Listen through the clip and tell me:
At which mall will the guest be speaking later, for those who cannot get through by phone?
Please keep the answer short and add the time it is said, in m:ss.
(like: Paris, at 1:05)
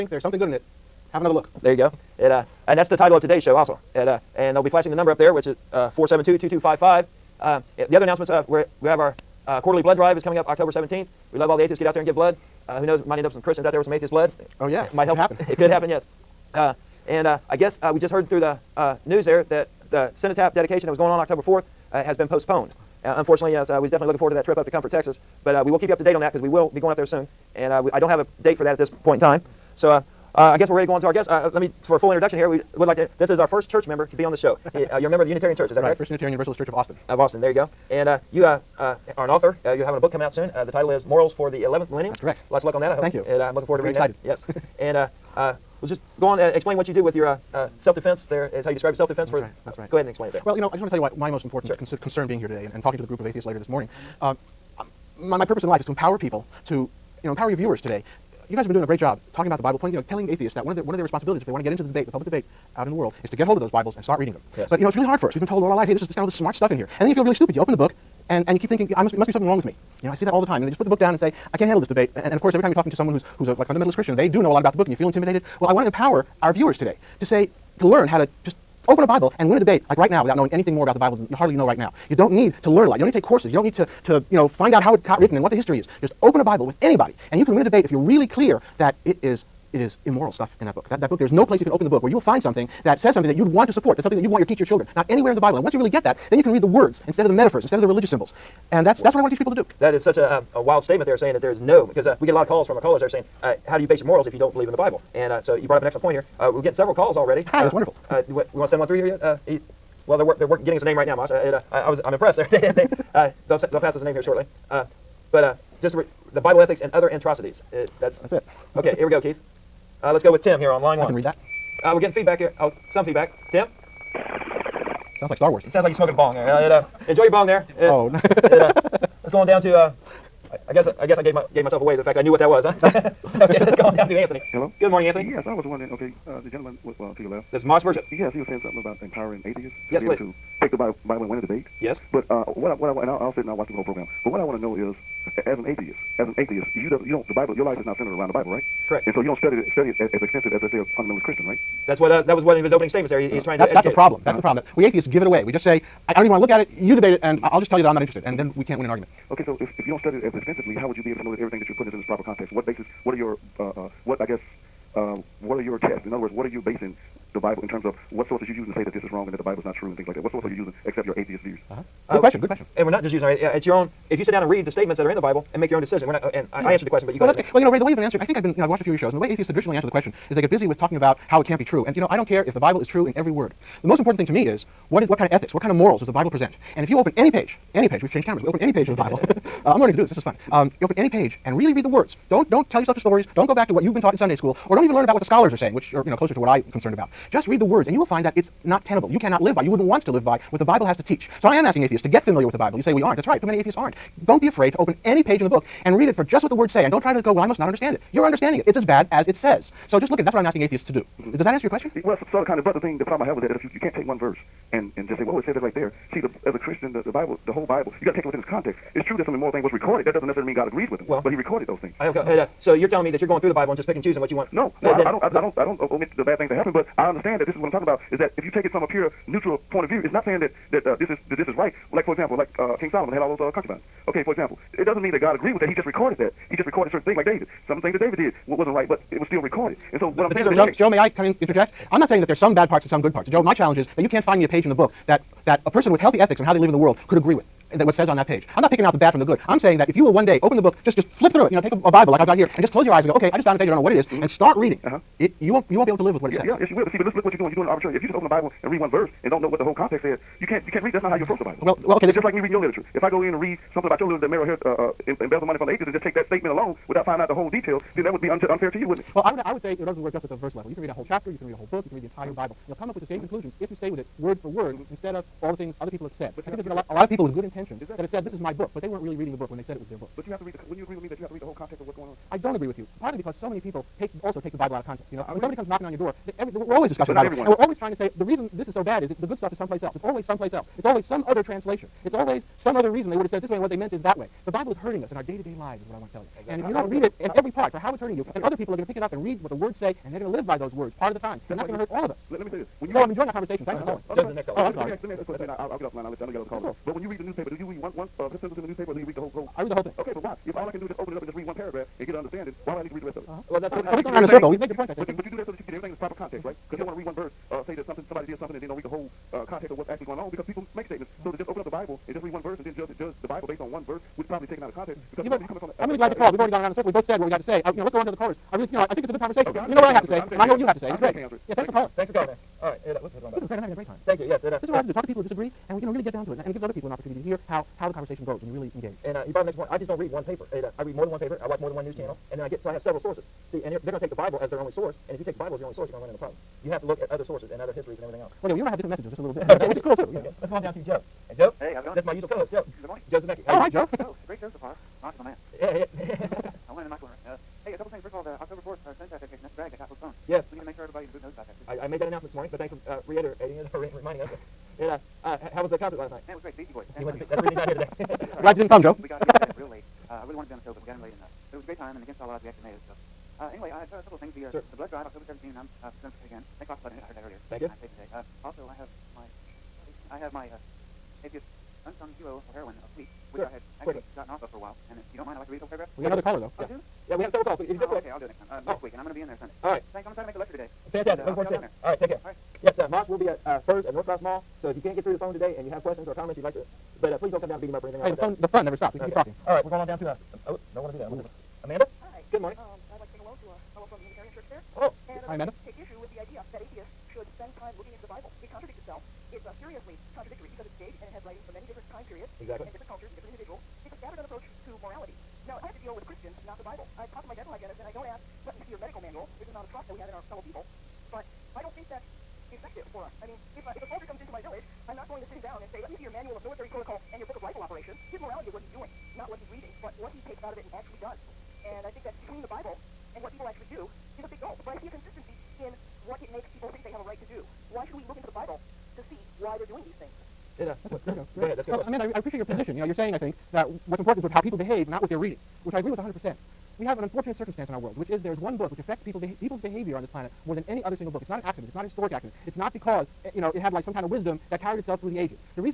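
North Cross Mall, at 6:33.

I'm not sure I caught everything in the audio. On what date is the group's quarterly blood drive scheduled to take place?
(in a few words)
October 17th.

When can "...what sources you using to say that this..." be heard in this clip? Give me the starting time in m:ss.
2:48.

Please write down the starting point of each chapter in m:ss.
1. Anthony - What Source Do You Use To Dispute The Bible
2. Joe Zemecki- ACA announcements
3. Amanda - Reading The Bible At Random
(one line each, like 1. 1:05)
1. 2:13
2. 5:50
3. 6:41.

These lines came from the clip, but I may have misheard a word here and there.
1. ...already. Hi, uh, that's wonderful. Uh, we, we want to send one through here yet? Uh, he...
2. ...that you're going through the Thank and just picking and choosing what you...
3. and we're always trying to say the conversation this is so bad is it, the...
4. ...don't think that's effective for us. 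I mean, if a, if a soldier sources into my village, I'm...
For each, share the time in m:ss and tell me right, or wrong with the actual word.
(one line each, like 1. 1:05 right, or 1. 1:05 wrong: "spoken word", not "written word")
1. 1:47 right
2. 3:43 wrong: "Bible", not "Thank"
3. 4:47 wrong: "reason", not "conversation"
4. 7:01 wrong: "comes", not "sources".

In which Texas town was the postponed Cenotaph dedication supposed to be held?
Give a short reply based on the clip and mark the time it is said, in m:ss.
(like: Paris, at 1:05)
Comfort, Texas, at 0:24.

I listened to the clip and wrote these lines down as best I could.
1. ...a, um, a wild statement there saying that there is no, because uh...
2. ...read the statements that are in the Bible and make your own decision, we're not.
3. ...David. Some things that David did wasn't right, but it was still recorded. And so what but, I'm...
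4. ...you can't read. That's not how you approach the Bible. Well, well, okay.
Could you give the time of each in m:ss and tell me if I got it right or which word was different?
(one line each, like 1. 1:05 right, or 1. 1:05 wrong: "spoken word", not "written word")
1. 1:40 right
2. 2:54 right
3. 3:57 right
4. 4:20 right.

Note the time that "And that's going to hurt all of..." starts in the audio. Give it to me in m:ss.
5:01.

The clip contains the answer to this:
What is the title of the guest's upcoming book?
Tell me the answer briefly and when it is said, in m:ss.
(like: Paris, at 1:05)
Morals for the 11th Millennium, at 0:41.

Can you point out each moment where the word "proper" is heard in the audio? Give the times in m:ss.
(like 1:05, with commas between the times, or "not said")
2:42, 5:15.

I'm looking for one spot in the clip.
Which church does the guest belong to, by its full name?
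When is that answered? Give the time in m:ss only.
0:35.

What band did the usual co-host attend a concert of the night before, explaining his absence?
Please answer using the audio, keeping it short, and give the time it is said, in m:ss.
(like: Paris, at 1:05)
The Beastie Boys, at 6:06.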